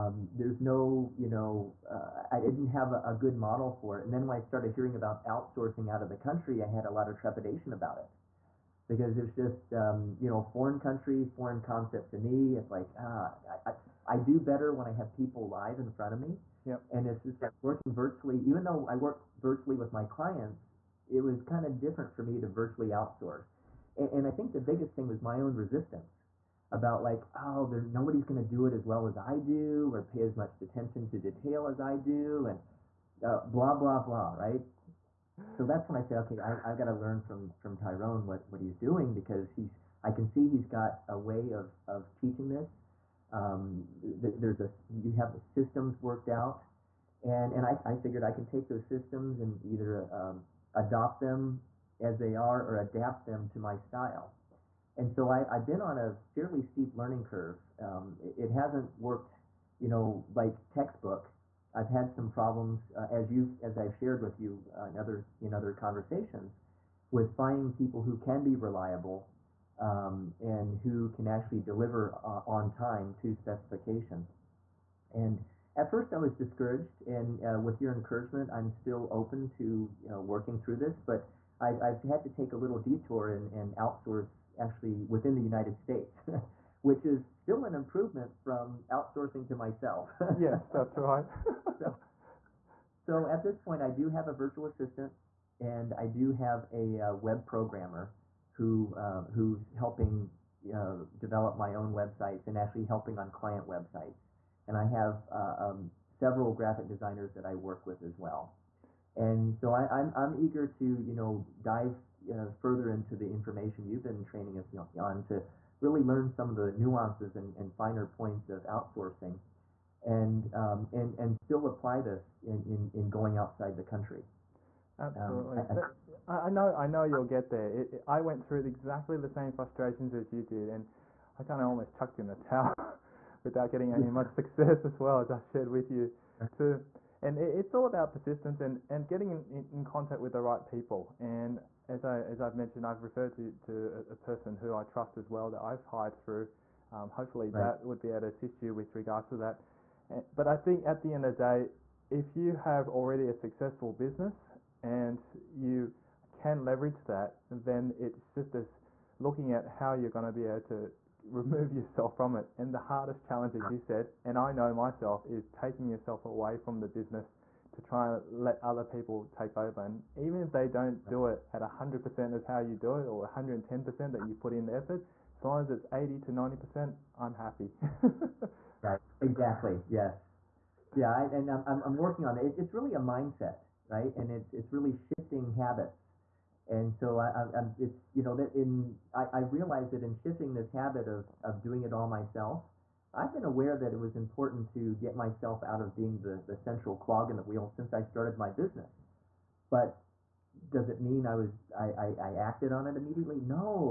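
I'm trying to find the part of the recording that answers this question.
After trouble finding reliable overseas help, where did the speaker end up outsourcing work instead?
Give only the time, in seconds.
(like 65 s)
85 s.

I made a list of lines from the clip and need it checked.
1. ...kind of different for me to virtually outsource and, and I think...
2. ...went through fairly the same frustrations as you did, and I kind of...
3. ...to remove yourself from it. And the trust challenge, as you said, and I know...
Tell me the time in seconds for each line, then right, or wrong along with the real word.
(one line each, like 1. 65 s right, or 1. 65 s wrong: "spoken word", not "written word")
1. 21 s right
2. 128 s wrong: "exactly", not "fairly"
3. 160 s wrong: "hardest", not "trust".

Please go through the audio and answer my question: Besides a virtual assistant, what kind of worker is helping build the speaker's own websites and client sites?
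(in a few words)
web programmer.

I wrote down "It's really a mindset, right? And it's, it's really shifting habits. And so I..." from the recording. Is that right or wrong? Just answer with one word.
right.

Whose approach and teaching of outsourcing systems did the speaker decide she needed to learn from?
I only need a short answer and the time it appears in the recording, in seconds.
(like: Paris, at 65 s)
Tyrone, at 37 s.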